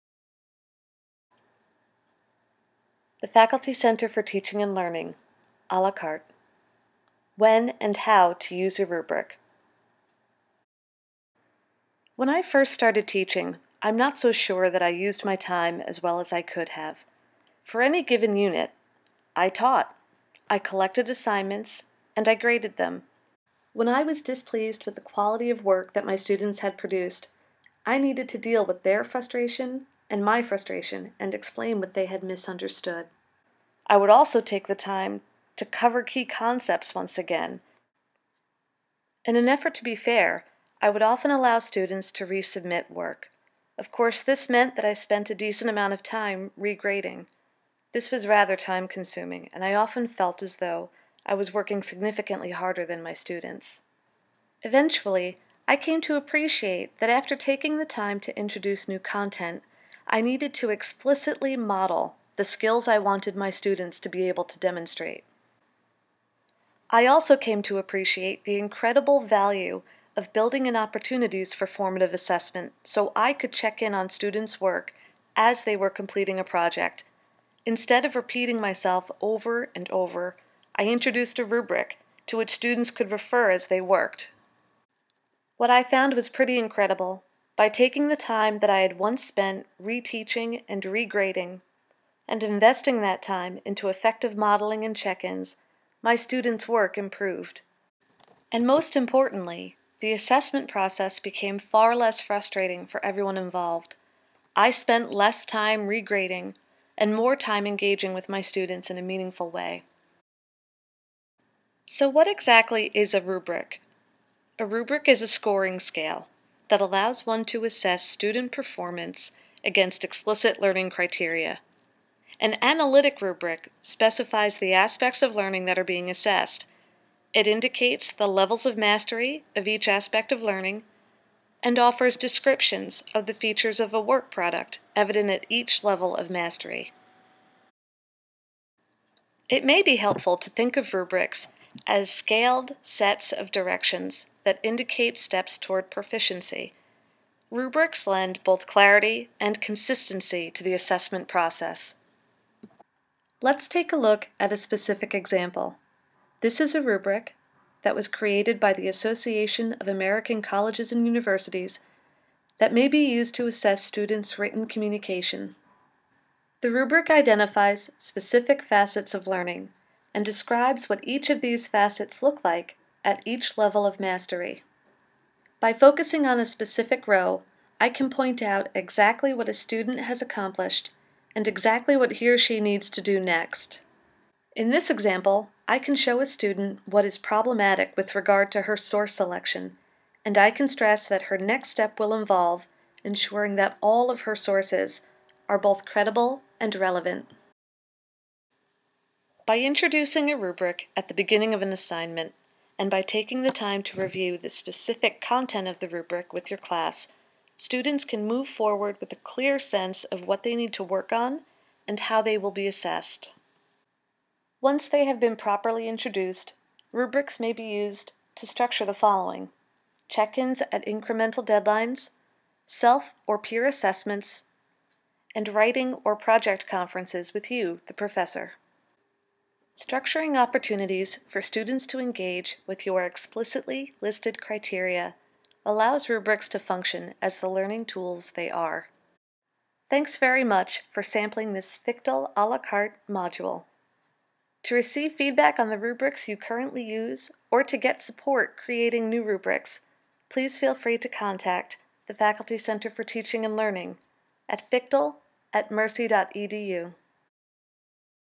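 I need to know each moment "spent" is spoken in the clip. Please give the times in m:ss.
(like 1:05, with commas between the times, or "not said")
0:44, 1:29, 1:44.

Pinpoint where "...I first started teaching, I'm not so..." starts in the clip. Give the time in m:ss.
0:12.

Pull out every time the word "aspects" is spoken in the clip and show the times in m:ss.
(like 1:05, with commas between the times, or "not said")
2:04, 2:09.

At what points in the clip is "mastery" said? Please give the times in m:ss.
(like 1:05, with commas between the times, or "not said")
2:08, 2:16, 2:53.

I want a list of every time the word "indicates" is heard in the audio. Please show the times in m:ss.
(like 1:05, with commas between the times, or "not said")
2:07, 2:24.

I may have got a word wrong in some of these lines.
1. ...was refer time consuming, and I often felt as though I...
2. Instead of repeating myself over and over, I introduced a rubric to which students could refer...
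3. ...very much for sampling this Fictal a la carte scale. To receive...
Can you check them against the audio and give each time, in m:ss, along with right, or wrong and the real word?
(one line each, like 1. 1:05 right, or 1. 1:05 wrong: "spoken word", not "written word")
1. 0:48 wrong: "rather", not "refer"
2. 1:17 right
3. 4:00 wrong: "module", not "scale".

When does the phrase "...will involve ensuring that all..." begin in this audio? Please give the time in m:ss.
3:11.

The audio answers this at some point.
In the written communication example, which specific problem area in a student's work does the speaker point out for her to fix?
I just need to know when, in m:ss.
3:08.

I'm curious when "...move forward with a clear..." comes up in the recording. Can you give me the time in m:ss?
3:28.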